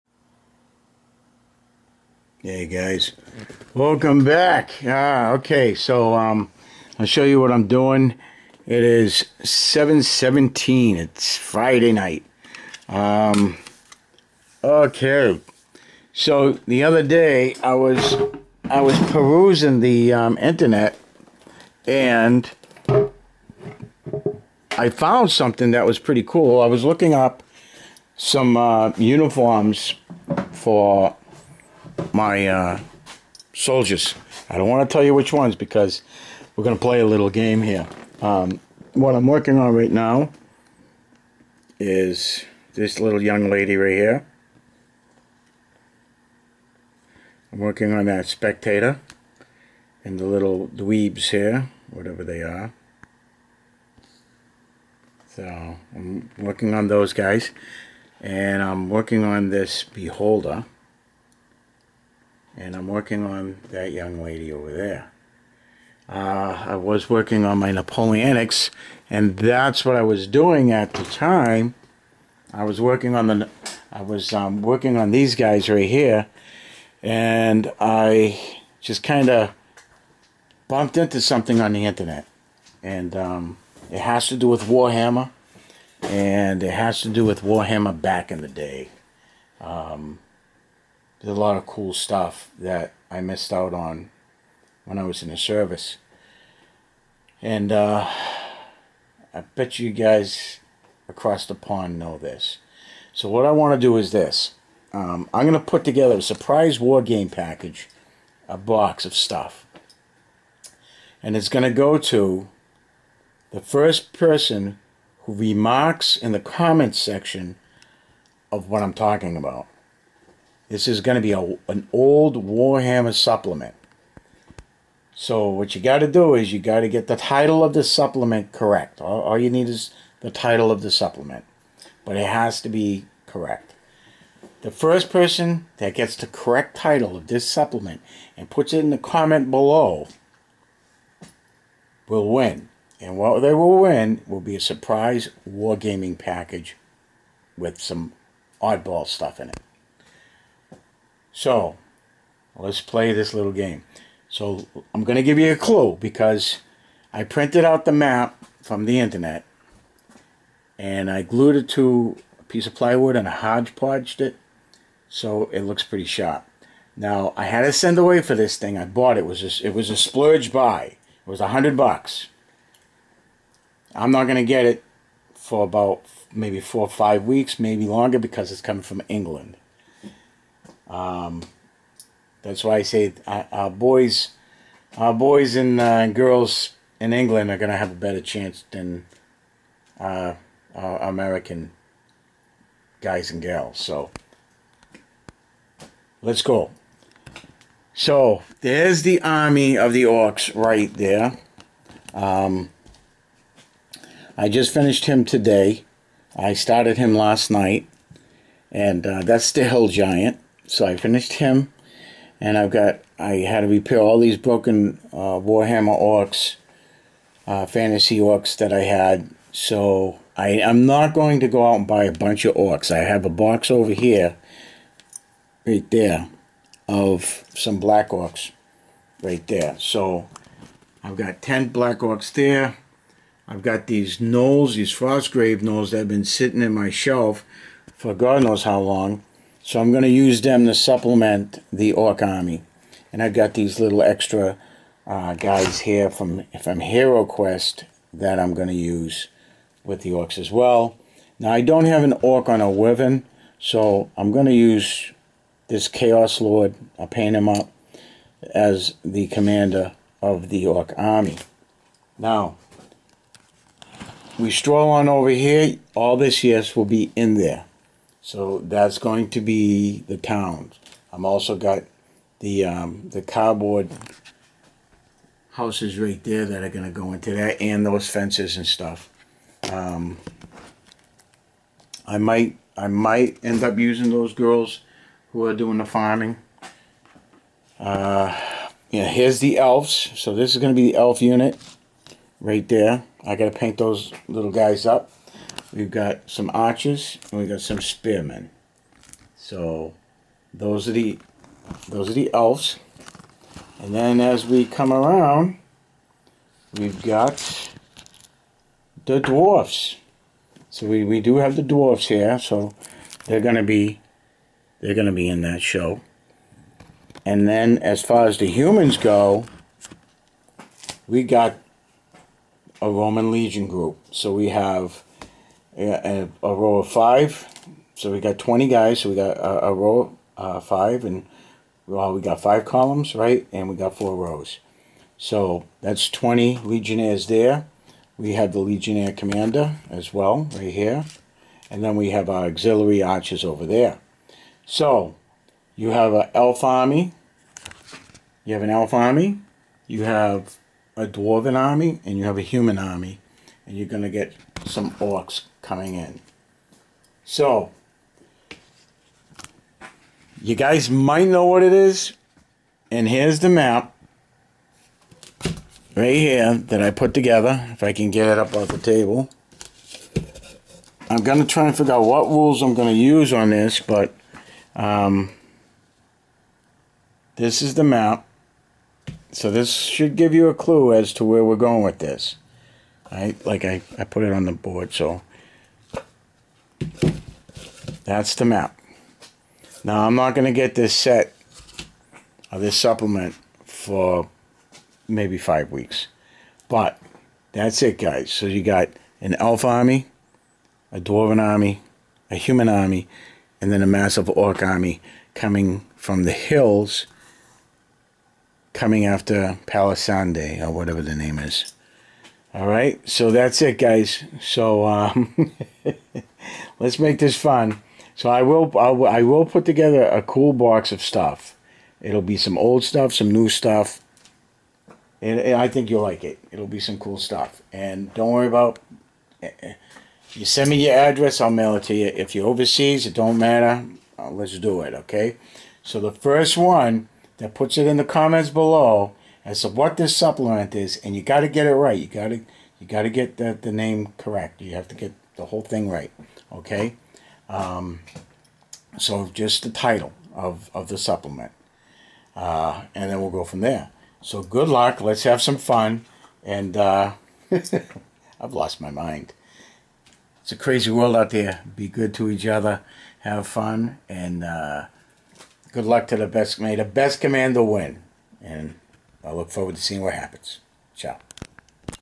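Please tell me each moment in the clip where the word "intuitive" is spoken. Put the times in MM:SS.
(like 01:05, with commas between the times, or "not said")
not said.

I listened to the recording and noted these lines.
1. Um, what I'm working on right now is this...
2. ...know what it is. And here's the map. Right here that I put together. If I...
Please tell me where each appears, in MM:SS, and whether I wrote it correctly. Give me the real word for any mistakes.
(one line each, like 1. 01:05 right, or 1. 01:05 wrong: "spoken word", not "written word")
1. 00:38 right
2. 06:01 right.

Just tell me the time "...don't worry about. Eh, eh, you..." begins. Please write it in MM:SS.
07:08.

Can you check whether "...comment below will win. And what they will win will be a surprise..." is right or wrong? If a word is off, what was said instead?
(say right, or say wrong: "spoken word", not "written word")
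right.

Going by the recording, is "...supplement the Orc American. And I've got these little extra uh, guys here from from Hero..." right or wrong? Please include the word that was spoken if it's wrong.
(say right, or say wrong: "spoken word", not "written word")
wrong: "Army", not "American".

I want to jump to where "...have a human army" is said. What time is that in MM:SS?
05:52.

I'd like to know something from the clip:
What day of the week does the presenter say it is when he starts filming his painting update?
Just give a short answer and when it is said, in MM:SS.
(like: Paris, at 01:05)
Friday, at 00:11.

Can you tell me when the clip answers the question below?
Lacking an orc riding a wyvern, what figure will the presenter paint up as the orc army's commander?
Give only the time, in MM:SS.
04:15.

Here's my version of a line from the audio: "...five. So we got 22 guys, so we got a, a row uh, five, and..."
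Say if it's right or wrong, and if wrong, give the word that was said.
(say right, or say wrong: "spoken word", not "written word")
wrong: "20", not "22".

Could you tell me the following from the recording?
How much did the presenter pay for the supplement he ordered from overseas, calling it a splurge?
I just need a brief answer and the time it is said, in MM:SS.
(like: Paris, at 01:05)
100 dollars, at 02:51.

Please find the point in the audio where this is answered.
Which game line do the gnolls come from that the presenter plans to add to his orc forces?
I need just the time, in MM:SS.
03:54.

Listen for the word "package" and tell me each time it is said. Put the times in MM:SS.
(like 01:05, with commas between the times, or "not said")
01:47, 02:26.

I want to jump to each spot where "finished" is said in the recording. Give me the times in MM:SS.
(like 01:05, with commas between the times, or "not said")
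03:24, 03:30.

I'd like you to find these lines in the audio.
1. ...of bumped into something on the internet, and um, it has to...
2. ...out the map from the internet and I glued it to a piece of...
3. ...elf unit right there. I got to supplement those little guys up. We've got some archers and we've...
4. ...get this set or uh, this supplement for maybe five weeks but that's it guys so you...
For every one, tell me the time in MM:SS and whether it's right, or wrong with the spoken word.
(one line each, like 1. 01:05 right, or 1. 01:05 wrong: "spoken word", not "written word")
1. 01:19 right
2. 02:37 right
3. 04:50 wrong: "paint", not "supplement"
4. 06:30 right.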